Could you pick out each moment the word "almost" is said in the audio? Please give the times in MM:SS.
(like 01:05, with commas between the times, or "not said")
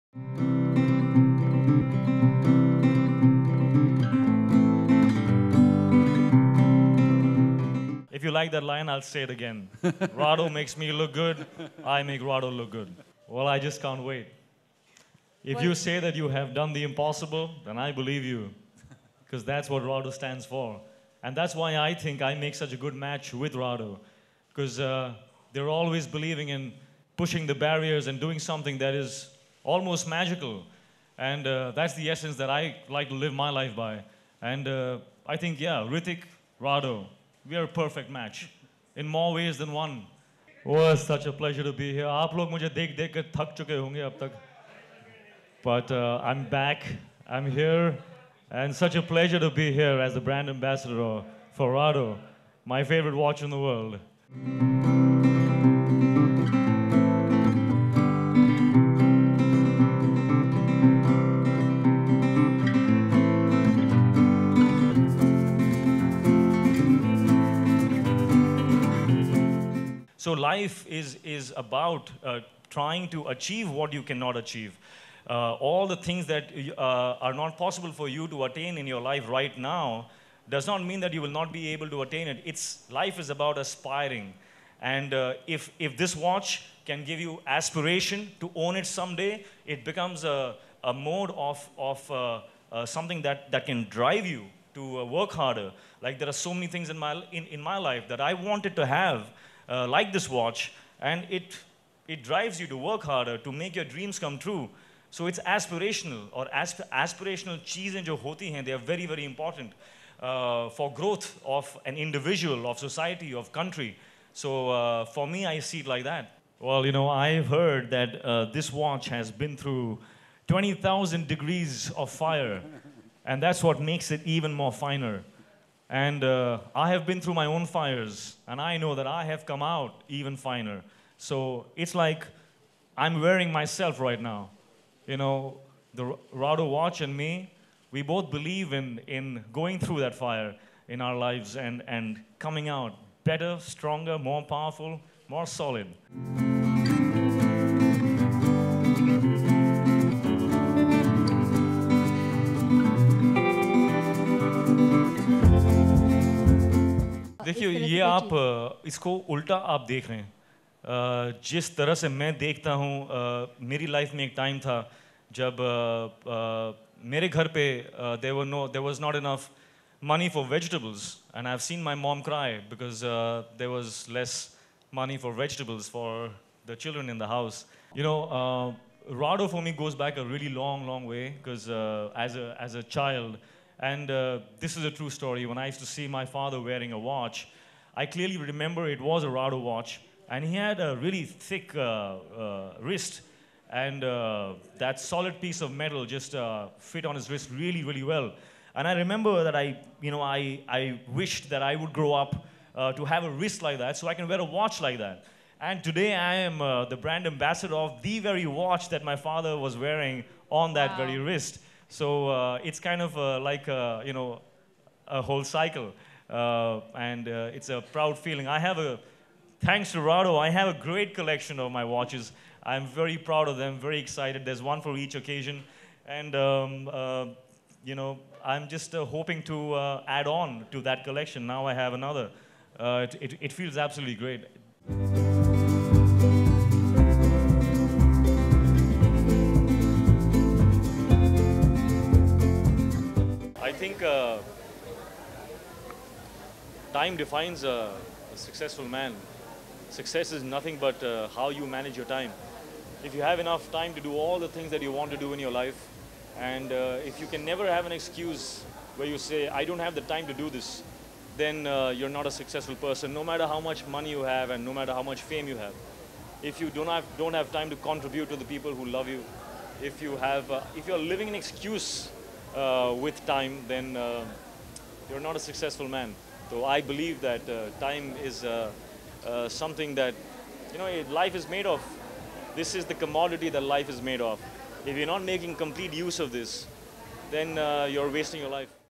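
00:29.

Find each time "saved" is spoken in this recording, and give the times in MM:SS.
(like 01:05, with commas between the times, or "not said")
not said.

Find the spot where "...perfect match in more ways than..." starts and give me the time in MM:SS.
00:37.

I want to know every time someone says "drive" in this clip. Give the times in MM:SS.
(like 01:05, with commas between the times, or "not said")
01:33, 01:42.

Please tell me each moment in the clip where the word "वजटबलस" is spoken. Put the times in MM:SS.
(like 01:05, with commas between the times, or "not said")
02:50, 02:55.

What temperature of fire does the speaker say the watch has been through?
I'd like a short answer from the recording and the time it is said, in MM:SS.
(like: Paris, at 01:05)
20,000 degrees, at 02:00.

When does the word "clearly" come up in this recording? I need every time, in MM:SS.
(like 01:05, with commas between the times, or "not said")
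03:08.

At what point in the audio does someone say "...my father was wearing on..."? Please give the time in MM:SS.
03:29.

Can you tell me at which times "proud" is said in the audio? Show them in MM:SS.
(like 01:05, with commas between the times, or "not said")
03:37, 03:43.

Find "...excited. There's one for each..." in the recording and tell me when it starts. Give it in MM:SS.
03:43.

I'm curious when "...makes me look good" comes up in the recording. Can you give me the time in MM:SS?
00:10.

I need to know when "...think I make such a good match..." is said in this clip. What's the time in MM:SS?
00:21.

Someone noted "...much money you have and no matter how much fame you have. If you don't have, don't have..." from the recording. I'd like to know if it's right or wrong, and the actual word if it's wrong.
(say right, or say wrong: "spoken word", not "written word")
right.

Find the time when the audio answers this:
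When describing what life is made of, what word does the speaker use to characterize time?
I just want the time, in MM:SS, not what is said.
04:42.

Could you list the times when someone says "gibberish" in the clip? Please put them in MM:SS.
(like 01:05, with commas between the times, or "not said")
not said.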